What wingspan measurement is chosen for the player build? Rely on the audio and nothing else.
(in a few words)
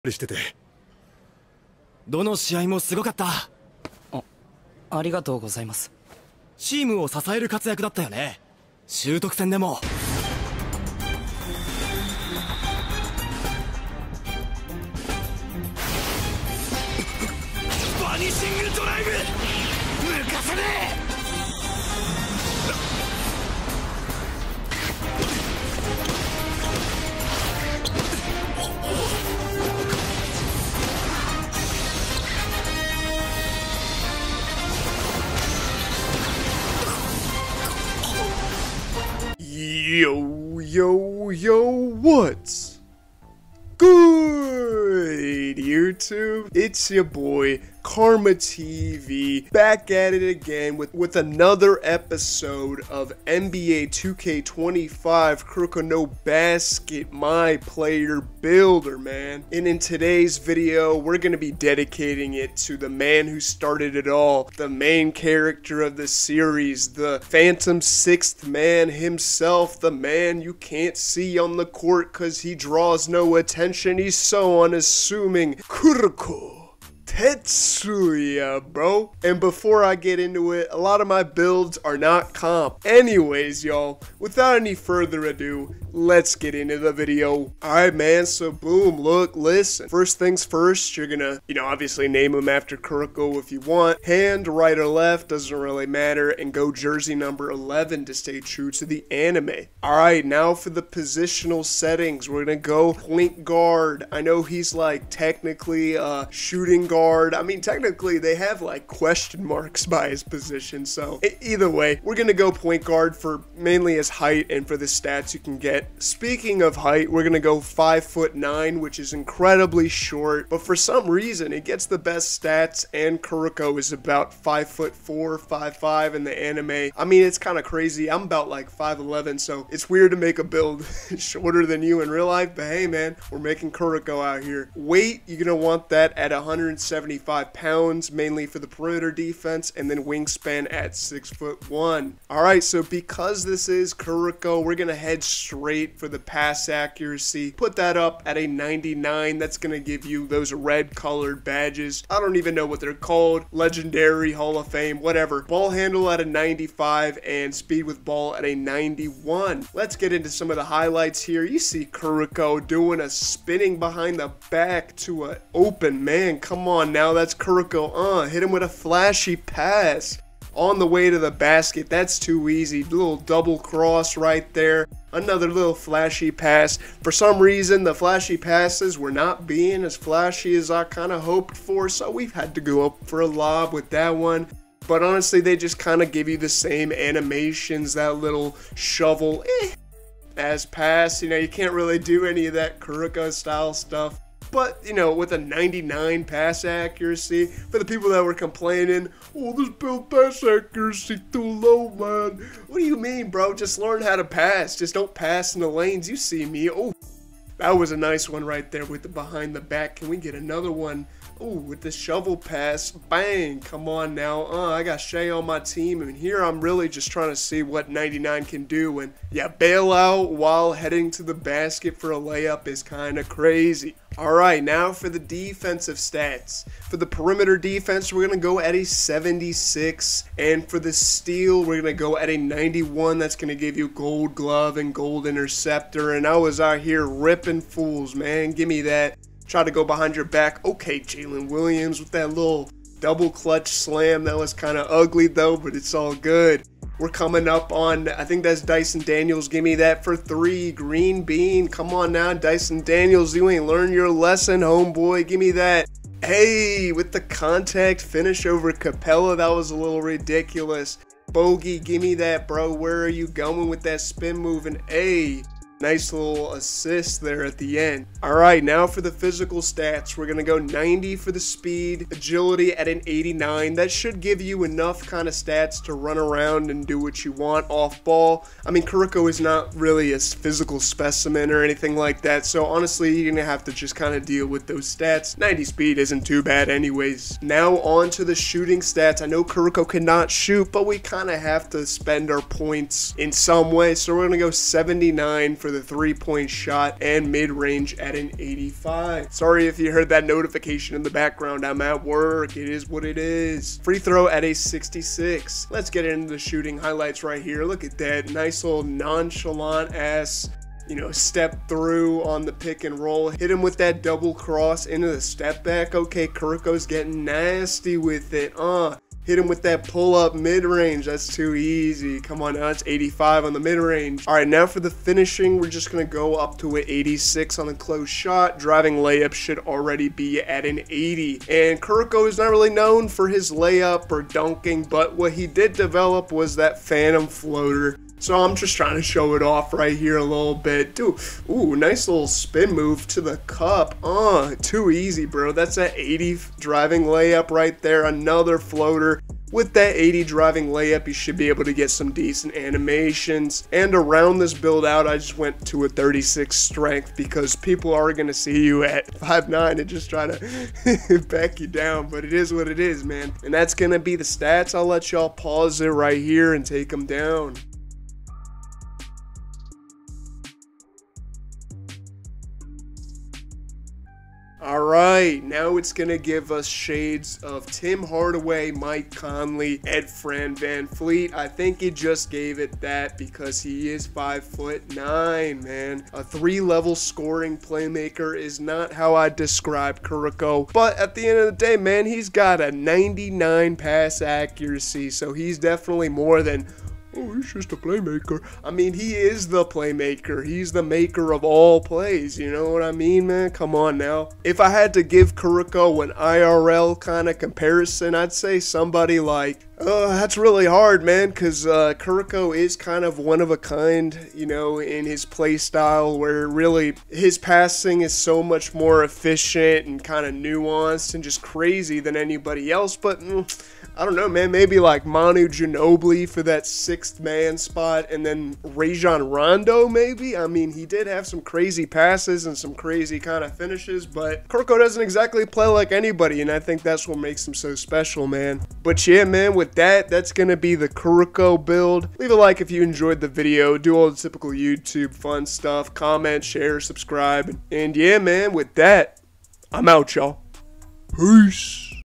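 6 foot 1.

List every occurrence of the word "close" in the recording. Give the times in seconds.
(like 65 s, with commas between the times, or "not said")
327 s.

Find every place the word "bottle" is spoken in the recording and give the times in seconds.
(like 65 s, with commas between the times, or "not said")
not said.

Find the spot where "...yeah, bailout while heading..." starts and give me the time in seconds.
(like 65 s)
219 s.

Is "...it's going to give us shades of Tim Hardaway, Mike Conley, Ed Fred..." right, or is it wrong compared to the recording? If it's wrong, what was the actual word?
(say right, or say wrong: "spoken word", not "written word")
right.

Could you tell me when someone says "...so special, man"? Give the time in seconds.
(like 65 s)
437 s.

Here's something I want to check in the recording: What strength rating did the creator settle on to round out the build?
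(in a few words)
36.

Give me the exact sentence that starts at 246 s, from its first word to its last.
We're coming up on, I think that's Dyson Daniels.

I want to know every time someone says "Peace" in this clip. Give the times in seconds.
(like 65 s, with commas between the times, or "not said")
451 s.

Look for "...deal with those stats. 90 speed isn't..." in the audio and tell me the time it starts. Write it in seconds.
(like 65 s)
284 s.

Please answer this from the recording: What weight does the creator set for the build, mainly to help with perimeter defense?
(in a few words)
175 pounds.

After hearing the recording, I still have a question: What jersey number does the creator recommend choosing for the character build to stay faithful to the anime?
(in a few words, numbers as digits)
11.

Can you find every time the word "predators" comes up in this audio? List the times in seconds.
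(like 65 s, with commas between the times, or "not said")
not said.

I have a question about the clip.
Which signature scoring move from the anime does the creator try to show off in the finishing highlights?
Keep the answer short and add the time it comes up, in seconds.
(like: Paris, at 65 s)
phantom floater, at 336 s.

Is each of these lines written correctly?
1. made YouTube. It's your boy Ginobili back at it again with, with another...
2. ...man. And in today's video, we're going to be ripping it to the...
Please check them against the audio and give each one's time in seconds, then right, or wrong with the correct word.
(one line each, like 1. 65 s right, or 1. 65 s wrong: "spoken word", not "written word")
1. 45 s wrong: "KarmaahTV", not "Ginobili"
2. 58 s wrong: "dedicating", not "ripping".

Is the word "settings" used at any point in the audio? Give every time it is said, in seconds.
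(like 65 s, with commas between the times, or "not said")
101 s.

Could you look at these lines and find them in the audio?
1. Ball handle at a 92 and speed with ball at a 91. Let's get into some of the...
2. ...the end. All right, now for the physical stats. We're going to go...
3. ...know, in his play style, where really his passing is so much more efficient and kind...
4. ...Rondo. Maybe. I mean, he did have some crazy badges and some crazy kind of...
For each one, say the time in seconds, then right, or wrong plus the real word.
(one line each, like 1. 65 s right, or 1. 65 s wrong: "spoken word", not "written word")
1. 155 s wrong: "95", not "92"
2. 267 s right
3. 414 s right
4. 429 s wrong: "passes", not "badges".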